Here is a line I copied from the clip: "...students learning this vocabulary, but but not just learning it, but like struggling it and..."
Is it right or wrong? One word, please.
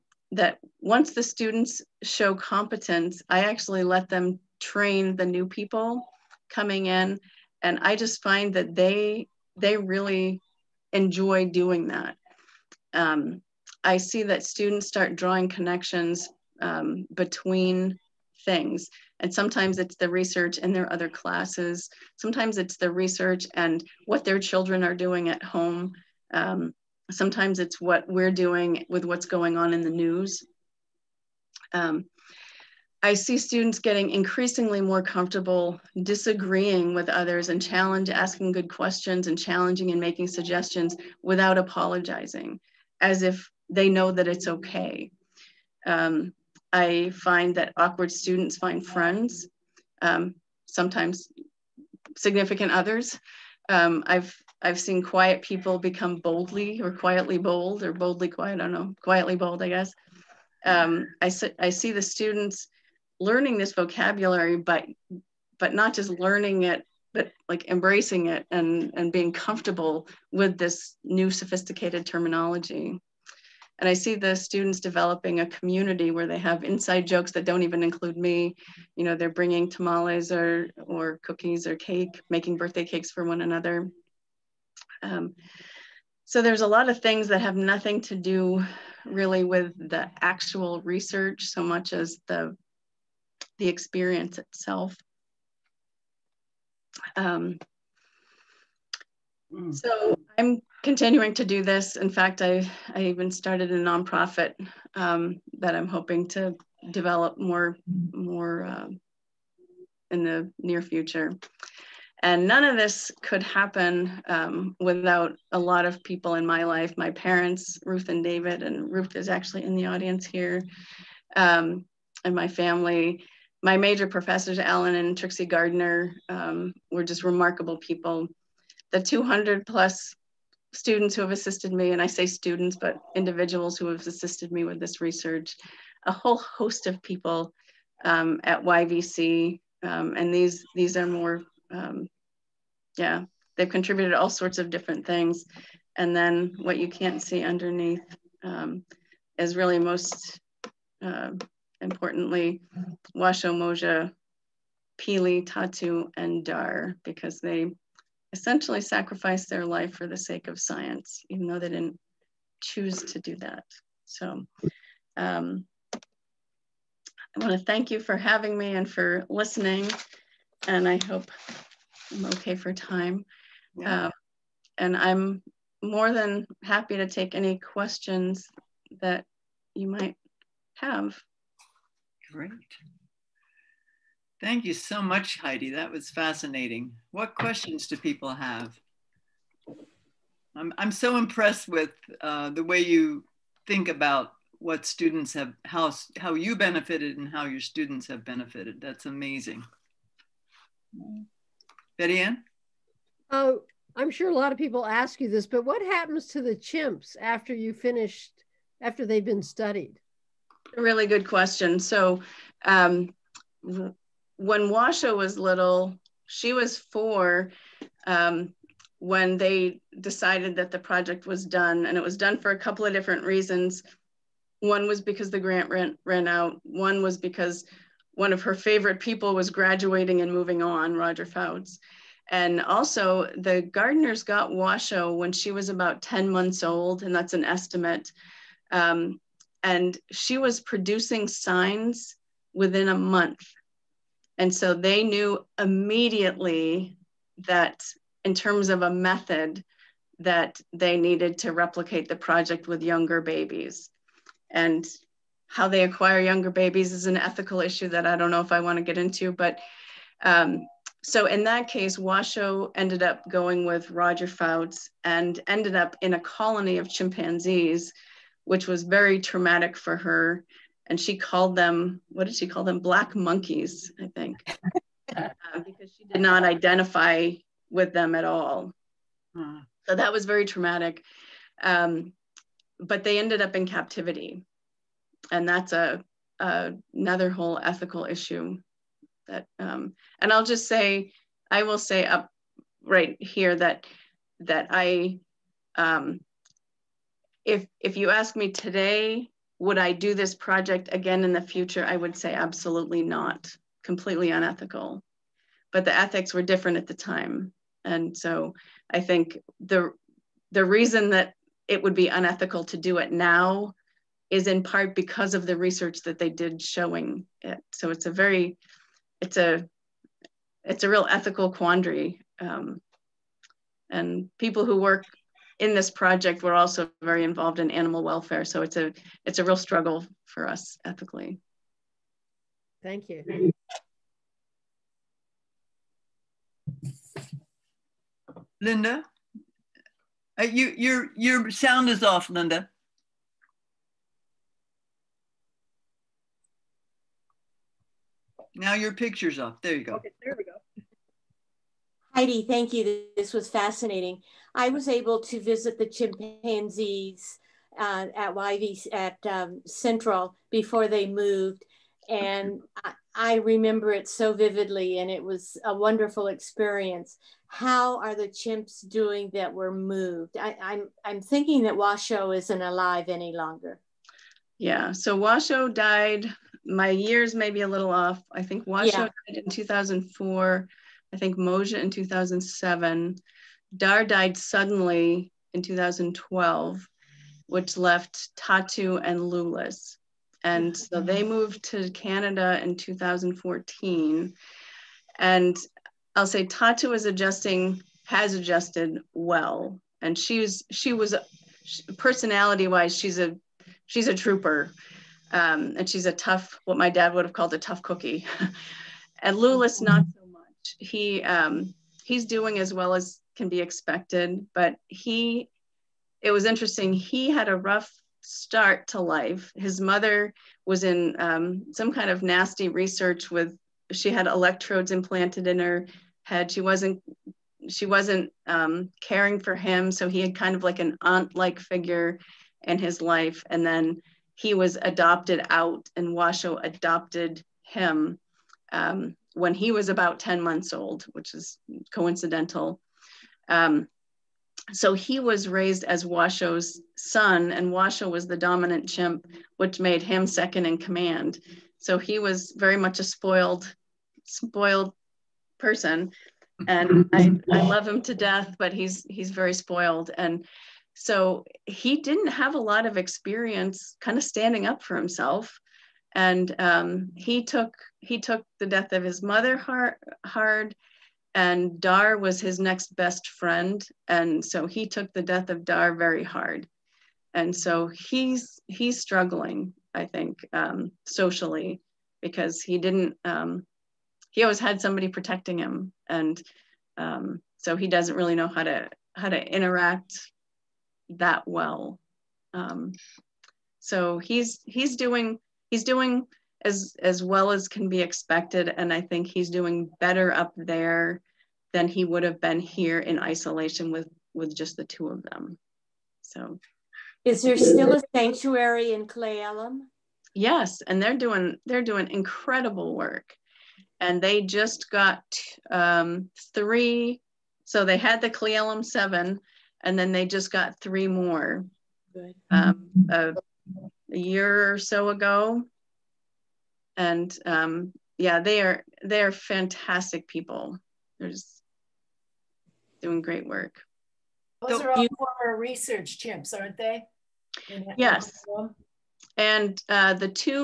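wrong.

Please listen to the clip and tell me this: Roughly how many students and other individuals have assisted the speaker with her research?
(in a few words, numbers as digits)
200 plus.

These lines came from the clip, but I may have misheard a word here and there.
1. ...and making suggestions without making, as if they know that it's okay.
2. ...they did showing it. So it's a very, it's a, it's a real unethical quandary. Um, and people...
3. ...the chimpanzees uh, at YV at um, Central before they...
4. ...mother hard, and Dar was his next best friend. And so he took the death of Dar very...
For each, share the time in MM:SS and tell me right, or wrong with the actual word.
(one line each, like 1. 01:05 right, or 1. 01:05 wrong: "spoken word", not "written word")
1. 00:39 wrong: "apologizing", not "making"
2. 05:16 wrong: "ethical", not "unethical"
3. 05:55 right
4. 07:49 right.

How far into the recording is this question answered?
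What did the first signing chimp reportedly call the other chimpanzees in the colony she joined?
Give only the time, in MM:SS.
04:32.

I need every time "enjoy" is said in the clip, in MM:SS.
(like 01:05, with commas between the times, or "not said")
00:10.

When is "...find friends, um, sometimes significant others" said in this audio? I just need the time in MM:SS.
00:48.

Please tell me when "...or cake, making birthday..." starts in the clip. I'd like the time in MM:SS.
01:21.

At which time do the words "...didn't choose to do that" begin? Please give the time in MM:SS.
02:41.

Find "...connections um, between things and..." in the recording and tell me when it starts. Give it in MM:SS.
00:15.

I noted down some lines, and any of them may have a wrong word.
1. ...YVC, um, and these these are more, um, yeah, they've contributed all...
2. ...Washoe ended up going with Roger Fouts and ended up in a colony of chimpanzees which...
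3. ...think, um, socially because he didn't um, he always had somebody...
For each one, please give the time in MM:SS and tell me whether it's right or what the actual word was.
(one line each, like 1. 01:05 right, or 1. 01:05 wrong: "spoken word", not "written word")
1. 02:18 right
2. 04:21 right
3. 08:00 right.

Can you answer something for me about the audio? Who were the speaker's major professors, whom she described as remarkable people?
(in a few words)
Allen and Trixie Gardner.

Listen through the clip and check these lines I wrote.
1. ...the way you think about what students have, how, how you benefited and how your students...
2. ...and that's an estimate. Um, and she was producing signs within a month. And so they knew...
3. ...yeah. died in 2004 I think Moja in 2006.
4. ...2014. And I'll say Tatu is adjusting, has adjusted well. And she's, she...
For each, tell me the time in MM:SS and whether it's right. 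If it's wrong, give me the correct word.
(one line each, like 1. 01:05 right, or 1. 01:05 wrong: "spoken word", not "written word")
1. 03:12 right
2. 03:57 right
3. 06:18 wrong: "2007", not "2006"
4. 06:32 right.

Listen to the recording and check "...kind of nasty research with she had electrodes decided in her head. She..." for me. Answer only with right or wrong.
wrong.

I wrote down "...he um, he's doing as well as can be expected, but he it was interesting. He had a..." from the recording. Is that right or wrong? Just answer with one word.
right.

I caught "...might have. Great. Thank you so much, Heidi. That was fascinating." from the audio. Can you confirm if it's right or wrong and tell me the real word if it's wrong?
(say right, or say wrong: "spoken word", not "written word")
right.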